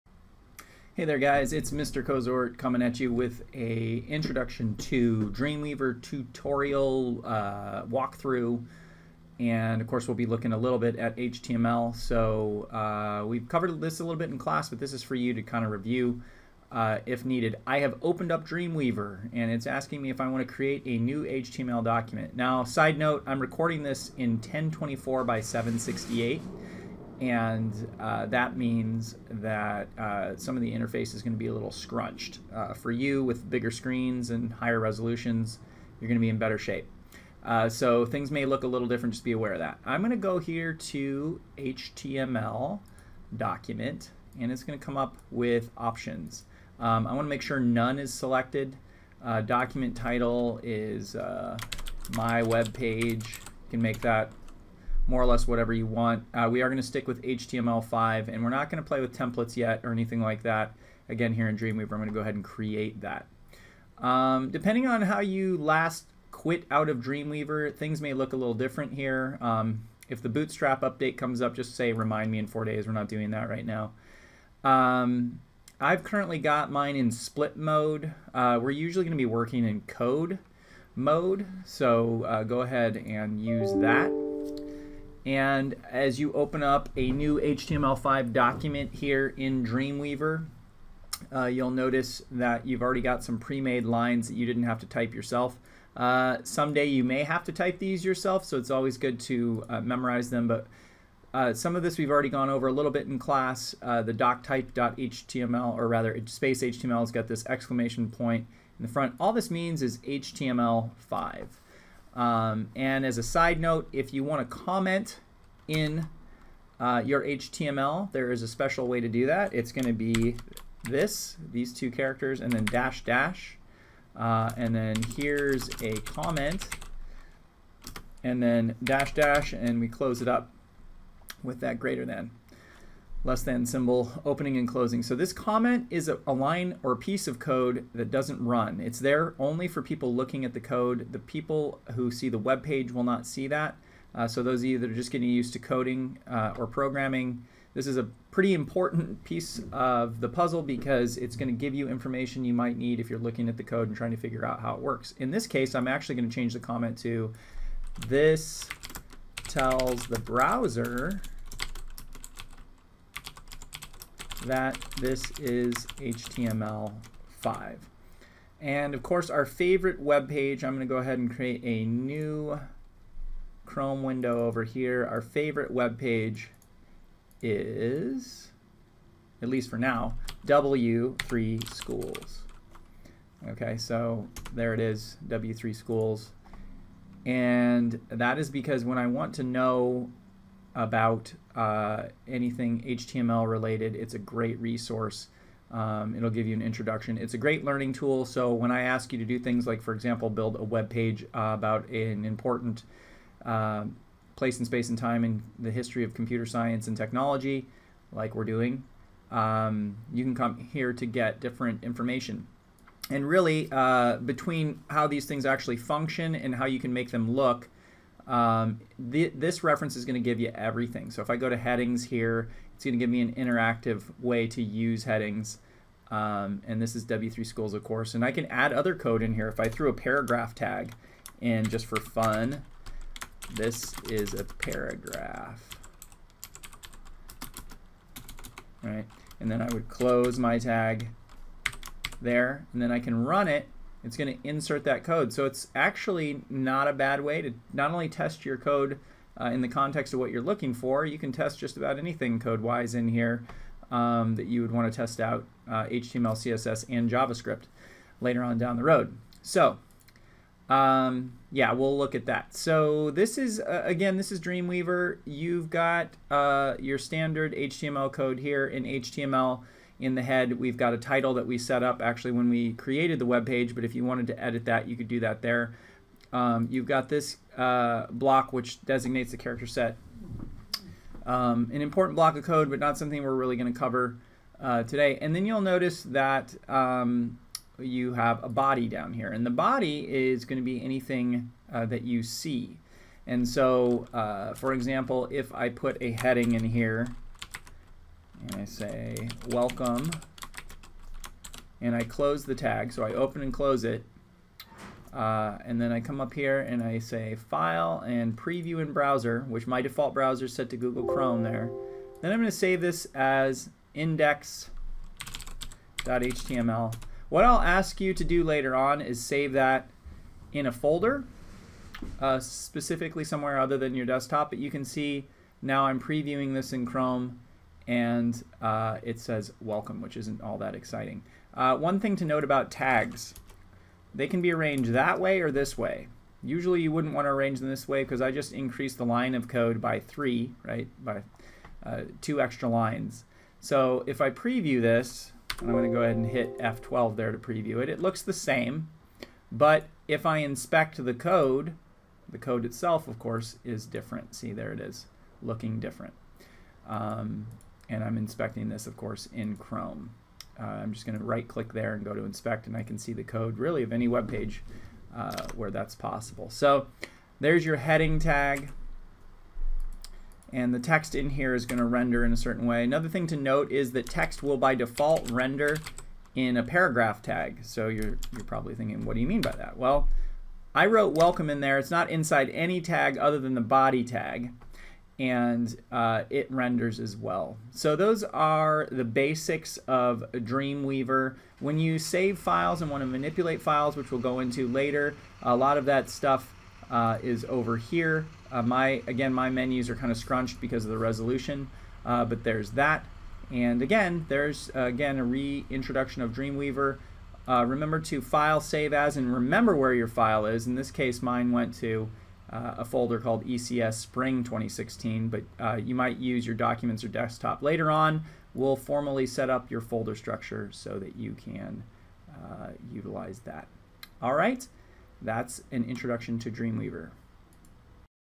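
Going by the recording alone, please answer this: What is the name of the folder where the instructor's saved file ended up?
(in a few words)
ECS Spring 2016.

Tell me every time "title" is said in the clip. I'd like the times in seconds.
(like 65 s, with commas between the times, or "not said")
49 s, 270 s.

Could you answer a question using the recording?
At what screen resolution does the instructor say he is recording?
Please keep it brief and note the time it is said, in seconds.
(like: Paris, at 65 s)
1024 by 768, at 24 s.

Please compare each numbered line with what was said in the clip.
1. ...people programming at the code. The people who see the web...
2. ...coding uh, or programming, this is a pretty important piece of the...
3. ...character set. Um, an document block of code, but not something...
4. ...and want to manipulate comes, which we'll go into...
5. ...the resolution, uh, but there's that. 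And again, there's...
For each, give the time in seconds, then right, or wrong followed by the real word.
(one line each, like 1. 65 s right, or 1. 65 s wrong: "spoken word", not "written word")
1. 139 s wrong: "looking", not "programming"
2. 145 s right
3. 279 s wrong: "important", not "document"
4. 392 s wrong: "files", not "comes"
5. 400 s right.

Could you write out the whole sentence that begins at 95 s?
Uh, someday you may have to type these yourself, so it's always good to uh, memorize them.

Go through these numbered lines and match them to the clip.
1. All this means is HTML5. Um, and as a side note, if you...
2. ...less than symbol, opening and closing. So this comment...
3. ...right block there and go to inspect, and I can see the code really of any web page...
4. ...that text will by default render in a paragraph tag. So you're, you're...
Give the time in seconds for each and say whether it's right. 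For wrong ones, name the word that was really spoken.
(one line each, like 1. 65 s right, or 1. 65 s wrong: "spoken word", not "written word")
1. 109 s right
2. 133 s right
3. 361 s wrong: "click", not "block"
4. 373 s right.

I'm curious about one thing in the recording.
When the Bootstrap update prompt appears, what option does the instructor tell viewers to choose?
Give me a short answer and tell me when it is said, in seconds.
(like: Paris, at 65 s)
remind me in four days, at 71 s.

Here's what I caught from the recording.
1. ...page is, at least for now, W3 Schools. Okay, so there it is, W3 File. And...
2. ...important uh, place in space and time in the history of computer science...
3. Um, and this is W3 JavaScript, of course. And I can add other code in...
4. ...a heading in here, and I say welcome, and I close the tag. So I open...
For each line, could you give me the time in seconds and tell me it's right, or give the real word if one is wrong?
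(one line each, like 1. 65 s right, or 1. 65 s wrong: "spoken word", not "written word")
1. 175 s wrong: "Schools", not "File"
2. 202 s right
3. 226 s wrong: "Schools", not "JavaScript"
4. 296 s right.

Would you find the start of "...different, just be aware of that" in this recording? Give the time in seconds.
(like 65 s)
38 s.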